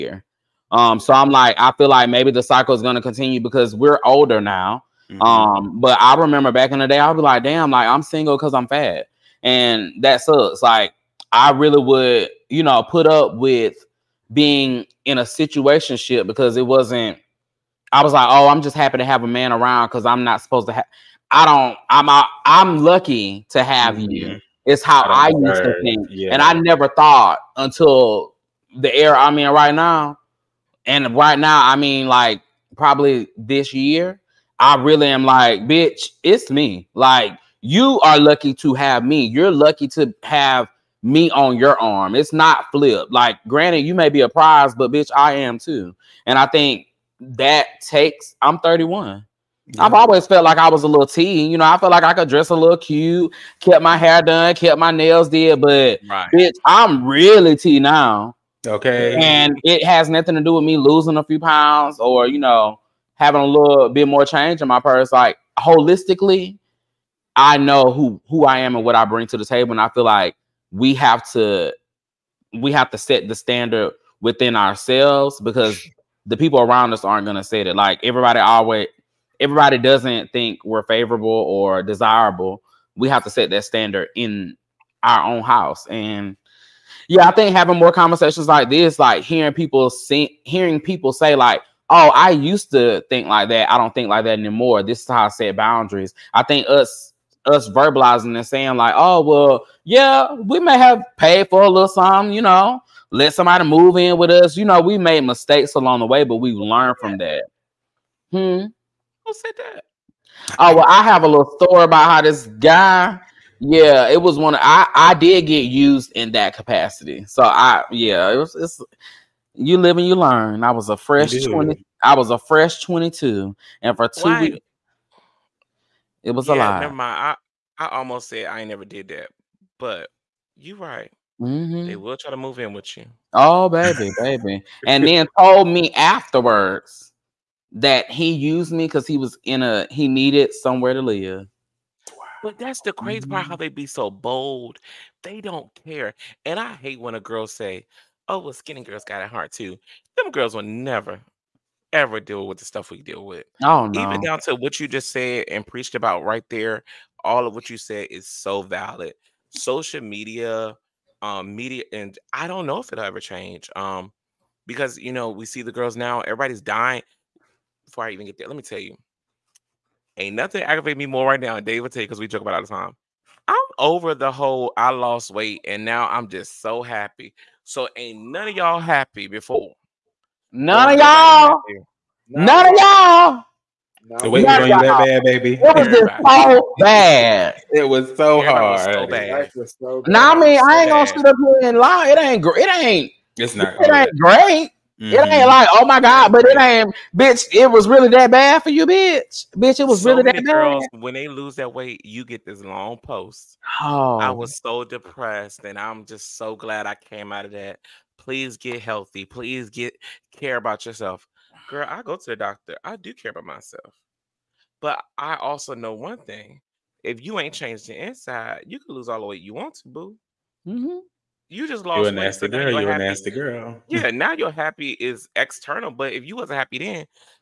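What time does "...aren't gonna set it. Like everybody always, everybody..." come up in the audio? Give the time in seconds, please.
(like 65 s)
77 s.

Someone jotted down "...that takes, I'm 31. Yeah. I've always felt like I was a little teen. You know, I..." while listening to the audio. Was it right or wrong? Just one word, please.
right.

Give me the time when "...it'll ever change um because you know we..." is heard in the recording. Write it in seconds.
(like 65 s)
162 s.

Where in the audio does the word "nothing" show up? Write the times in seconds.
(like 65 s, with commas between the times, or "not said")
60 s, 170 s.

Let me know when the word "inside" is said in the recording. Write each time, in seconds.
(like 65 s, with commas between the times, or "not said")
217 s.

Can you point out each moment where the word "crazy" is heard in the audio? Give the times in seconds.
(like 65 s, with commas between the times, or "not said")
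142 s.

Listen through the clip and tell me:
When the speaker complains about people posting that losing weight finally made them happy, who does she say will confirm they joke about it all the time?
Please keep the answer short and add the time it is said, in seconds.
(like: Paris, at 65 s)
Dave, at 171 s.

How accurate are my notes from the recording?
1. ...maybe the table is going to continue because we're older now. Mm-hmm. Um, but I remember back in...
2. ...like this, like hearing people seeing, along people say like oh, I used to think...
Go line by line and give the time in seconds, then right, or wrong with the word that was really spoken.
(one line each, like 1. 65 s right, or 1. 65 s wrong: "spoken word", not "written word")
1. 2 s wrong: "cycle", not "table"
2. 88 s wrong: "hearing", not "along".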